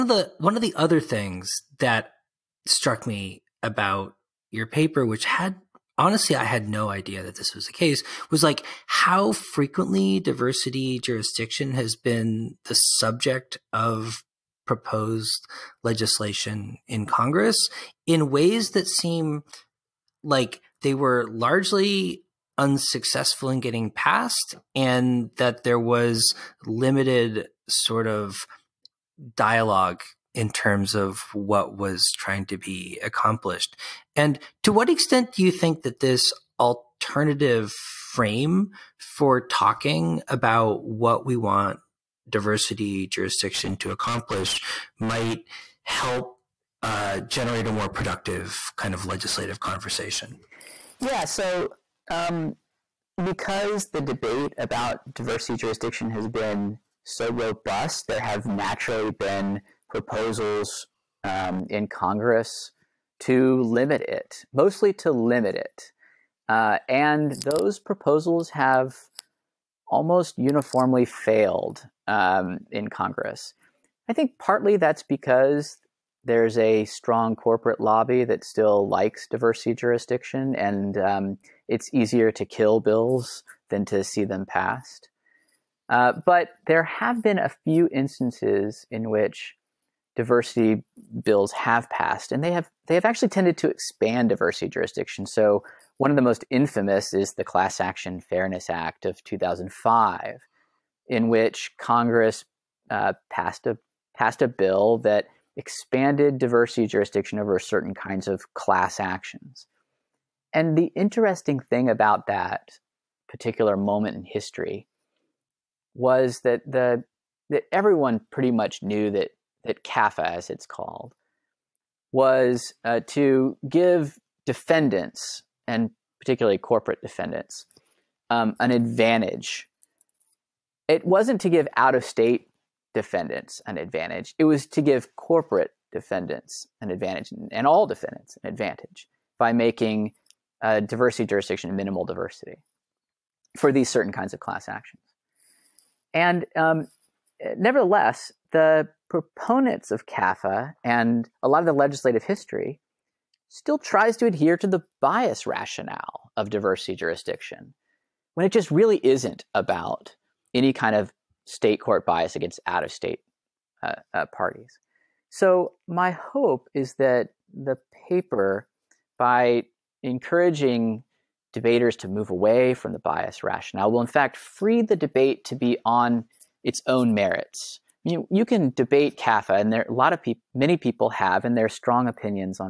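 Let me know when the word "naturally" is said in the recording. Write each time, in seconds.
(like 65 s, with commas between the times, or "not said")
58 s.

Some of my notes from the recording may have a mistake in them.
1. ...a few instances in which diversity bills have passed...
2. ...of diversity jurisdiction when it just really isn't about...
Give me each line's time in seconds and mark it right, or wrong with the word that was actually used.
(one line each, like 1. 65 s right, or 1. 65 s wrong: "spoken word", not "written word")
1. 87 s right
2. 156 s right.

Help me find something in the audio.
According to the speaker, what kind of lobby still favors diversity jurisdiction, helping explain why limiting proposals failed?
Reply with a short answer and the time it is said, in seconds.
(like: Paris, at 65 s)
corporate lobby, at 77 s.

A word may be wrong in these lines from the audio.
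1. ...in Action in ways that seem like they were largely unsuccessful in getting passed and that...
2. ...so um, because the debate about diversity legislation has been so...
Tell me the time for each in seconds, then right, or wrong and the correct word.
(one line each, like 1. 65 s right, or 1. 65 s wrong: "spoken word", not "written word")
1. 16 s wrong: "Congress", not "Action"
2. 51 s wrong: "jurisdiction", not "legislation".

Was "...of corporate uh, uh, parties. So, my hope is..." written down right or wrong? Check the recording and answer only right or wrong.
wrong.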